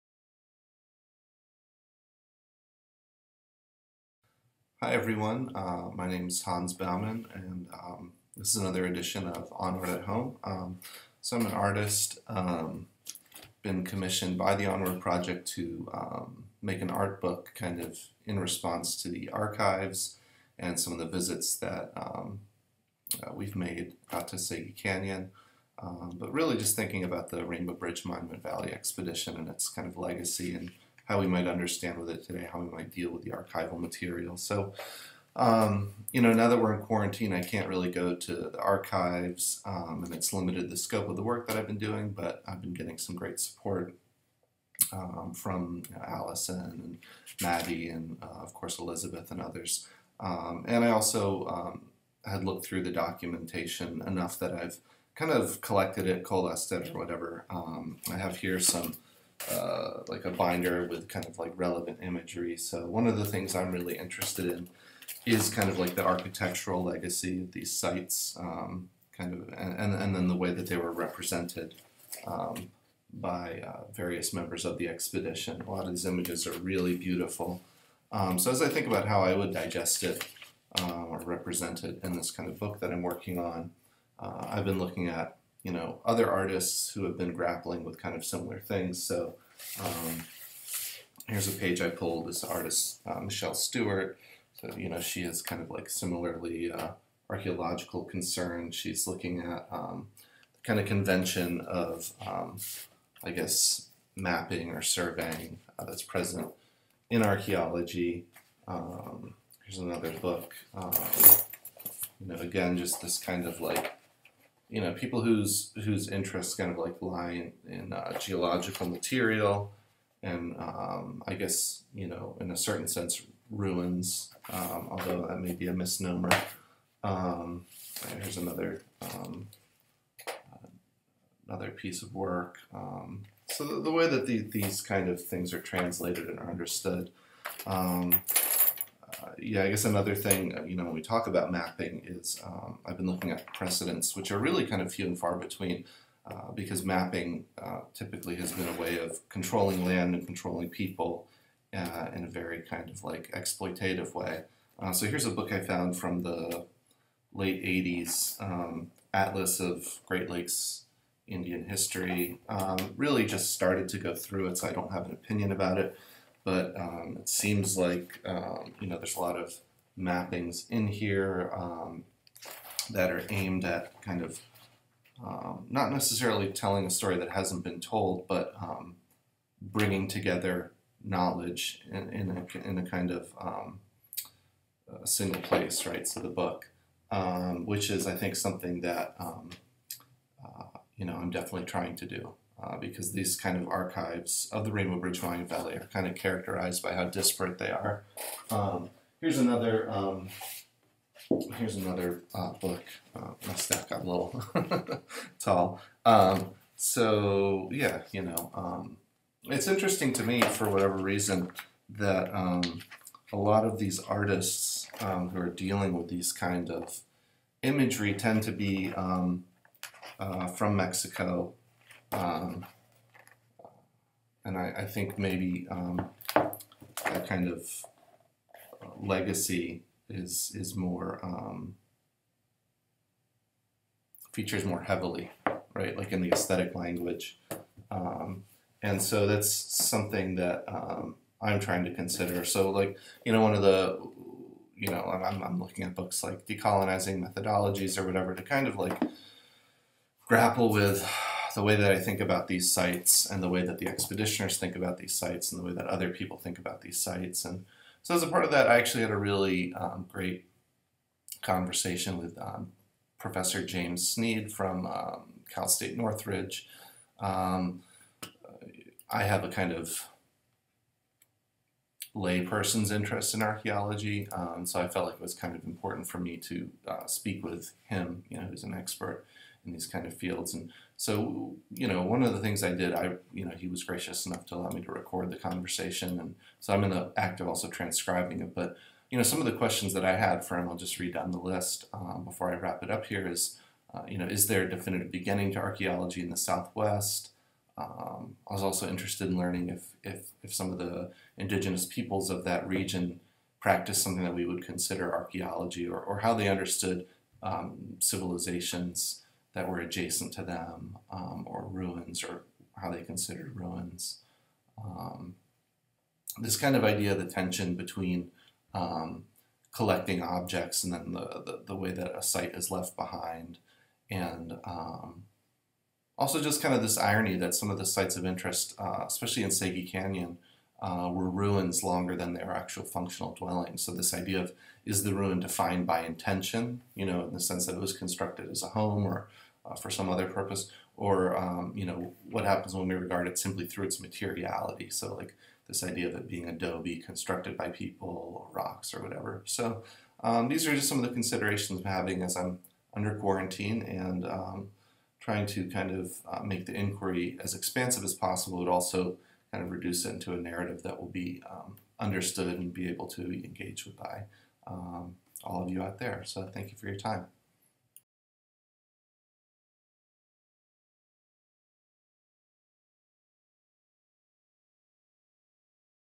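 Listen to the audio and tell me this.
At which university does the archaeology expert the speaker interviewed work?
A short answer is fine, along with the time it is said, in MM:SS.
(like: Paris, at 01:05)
Cal State Northridge, at 04:25.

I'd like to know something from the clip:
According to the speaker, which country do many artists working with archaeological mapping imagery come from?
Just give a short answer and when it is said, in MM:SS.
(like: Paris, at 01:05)
Mexico, at 03:40.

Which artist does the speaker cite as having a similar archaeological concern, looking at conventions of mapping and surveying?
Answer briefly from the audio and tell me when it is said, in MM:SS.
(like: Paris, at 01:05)
Michelle Stuart, at 01:33.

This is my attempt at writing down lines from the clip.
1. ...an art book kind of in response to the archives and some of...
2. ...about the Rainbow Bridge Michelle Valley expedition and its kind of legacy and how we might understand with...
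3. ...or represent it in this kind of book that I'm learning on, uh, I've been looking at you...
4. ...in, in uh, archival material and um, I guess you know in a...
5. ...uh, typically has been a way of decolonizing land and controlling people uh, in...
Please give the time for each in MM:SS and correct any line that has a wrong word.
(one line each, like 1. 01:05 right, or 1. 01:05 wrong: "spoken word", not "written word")
1. 00:16 right
2. 00:27 wrong: "Monument", not "Michelle"
3. 01:21 wrong: "working", not "learning"
4. 01:57 wrong: "geological", not "archival"
5. 02:27 wrong: "controlling", not "decolonizing".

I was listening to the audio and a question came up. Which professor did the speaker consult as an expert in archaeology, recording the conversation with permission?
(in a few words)
James Snead.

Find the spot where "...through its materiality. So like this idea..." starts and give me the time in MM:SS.
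05:43.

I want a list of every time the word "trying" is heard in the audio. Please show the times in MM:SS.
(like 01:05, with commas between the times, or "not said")
03:11, 04:01, 05:55.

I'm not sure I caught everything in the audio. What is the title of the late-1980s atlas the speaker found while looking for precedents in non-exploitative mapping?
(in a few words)
Atlas of Great Lakes Indian History.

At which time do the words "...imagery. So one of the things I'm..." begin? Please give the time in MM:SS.
01:02.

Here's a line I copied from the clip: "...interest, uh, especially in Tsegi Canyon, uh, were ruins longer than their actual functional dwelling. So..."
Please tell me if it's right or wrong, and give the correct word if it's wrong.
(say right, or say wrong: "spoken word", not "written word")
right.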